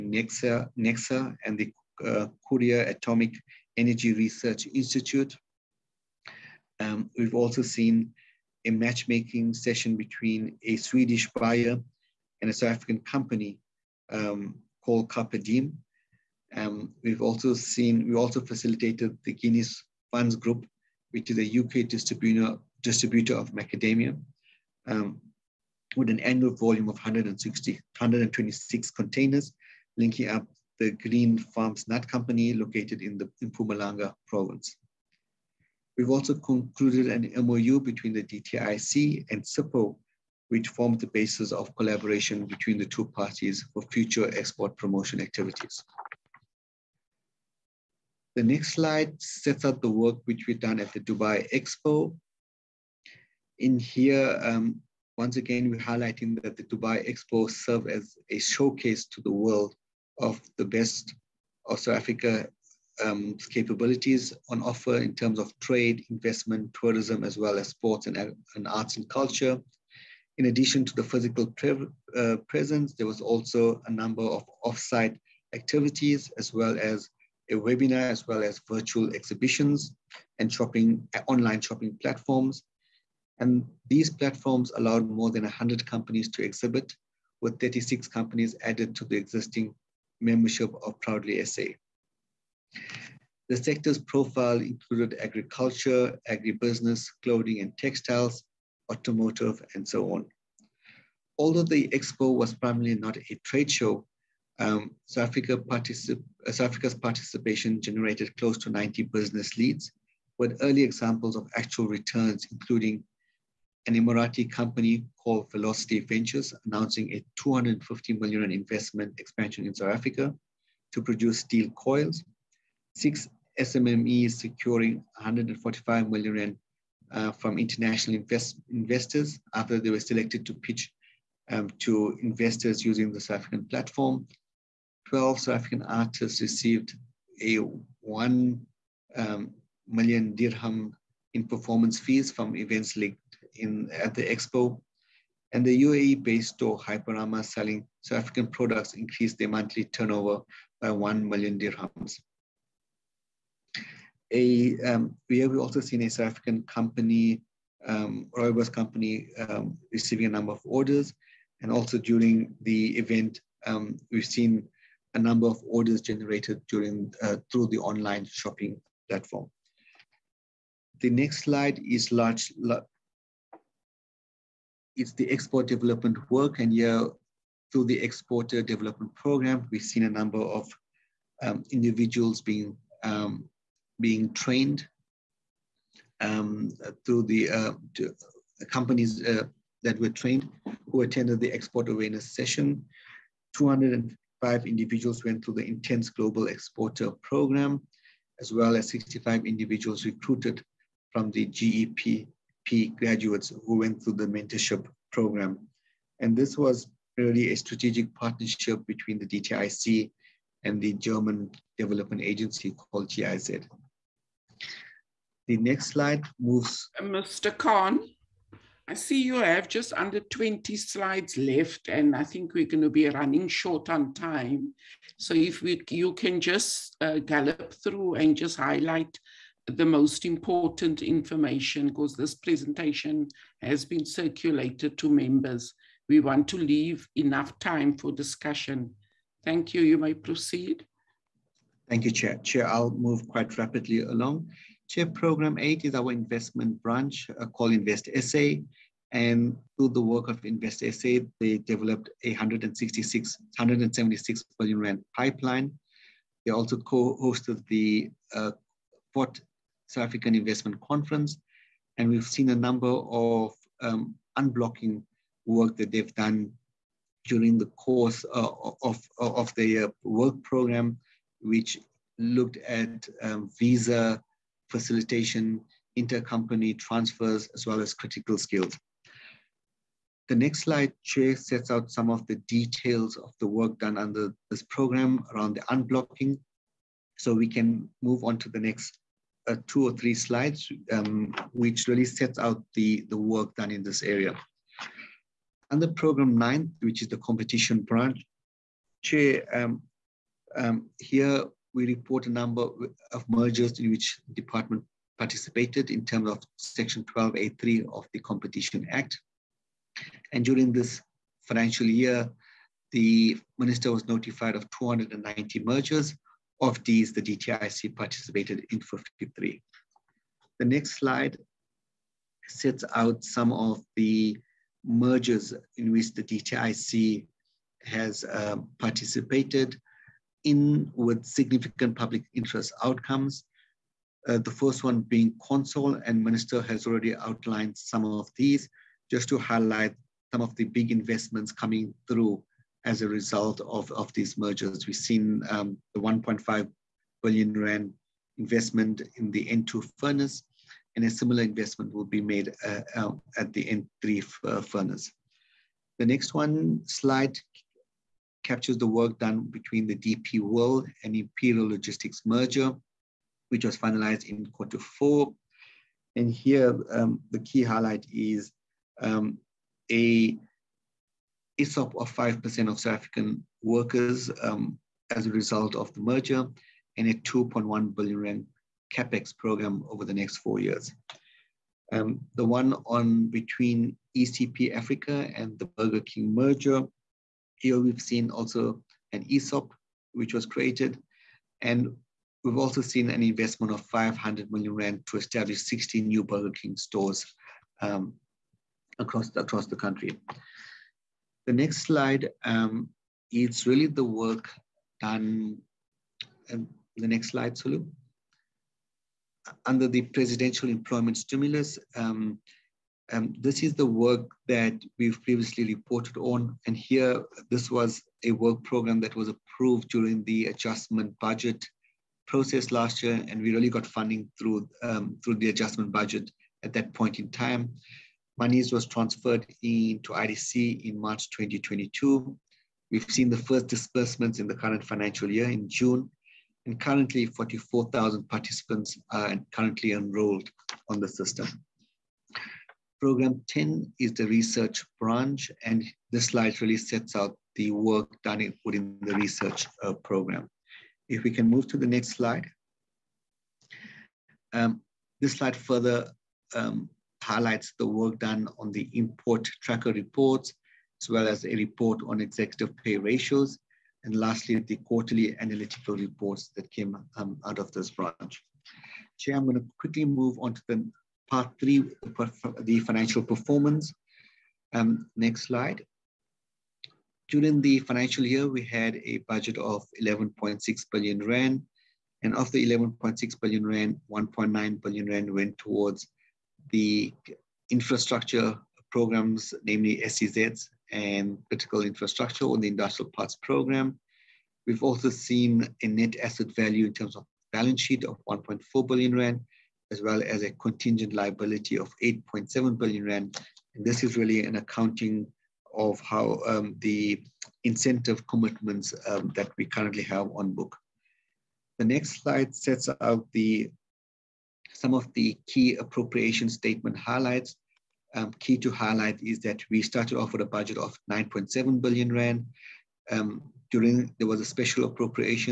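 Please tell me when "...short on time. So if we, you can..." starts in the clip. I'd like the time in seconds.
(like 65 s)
223 s.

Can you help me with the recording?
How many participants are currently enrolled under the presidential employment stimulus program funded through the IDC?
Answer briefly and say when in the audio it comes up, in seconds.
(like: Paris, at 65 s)
44,000, at 437 s.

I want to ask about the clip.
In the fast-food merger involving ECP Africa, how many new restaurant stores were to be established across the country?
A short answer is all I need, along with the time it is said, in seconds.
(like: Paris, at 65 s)
60, at 395 s.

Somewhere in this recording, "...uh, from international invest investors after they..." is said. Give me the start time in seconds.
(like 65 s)
127 s.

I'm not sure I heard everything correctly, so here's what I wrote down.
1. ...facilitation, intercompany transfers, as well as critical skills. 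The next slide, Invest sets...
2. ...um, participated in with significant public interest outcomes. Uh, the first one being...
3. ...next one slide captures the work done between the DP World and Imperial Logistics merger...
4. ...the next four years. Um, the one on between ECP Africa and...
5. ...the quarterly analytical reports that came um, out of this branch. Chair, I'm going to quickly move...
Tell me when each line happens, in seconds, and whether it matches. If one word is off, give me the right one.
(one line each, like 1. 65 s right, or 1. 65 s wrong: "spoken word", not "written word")
1. 274 s wrong: "Chue", not "Invest"
2. 328 s right
3. 356 s right
4. 380 s right
5. 464 s right.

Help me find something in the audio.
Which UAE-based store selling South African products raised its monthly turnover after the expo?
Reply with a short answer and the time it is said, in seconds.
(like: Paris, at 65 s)
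Hyperama, at 146 s.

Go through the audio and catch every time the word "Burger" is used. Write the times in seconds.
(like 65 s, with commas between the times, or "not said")
385 s, 396 s.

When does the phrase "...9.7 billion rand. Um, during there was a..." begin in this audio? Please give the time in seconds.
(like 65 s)
521 s.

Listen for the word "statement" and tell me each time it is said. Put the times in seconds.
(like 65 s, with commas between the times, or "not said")
516 s.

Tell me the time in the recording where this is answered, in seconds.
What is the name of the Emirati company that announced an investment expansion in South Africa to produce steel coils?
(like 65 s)
115 s.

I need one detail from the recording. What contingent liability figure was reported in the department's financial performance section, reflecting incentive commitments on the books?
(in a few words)
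8.7 billion rand.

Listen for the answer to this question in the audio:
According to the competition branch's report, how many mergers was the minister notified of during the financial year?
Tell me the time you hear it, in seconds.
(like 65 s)
314 s.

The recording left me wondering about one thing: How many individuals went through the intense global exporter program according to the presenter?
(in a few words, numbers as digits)
205.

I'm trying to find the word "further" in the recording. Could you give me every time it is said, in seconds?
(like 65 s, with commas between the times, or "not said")
455 s.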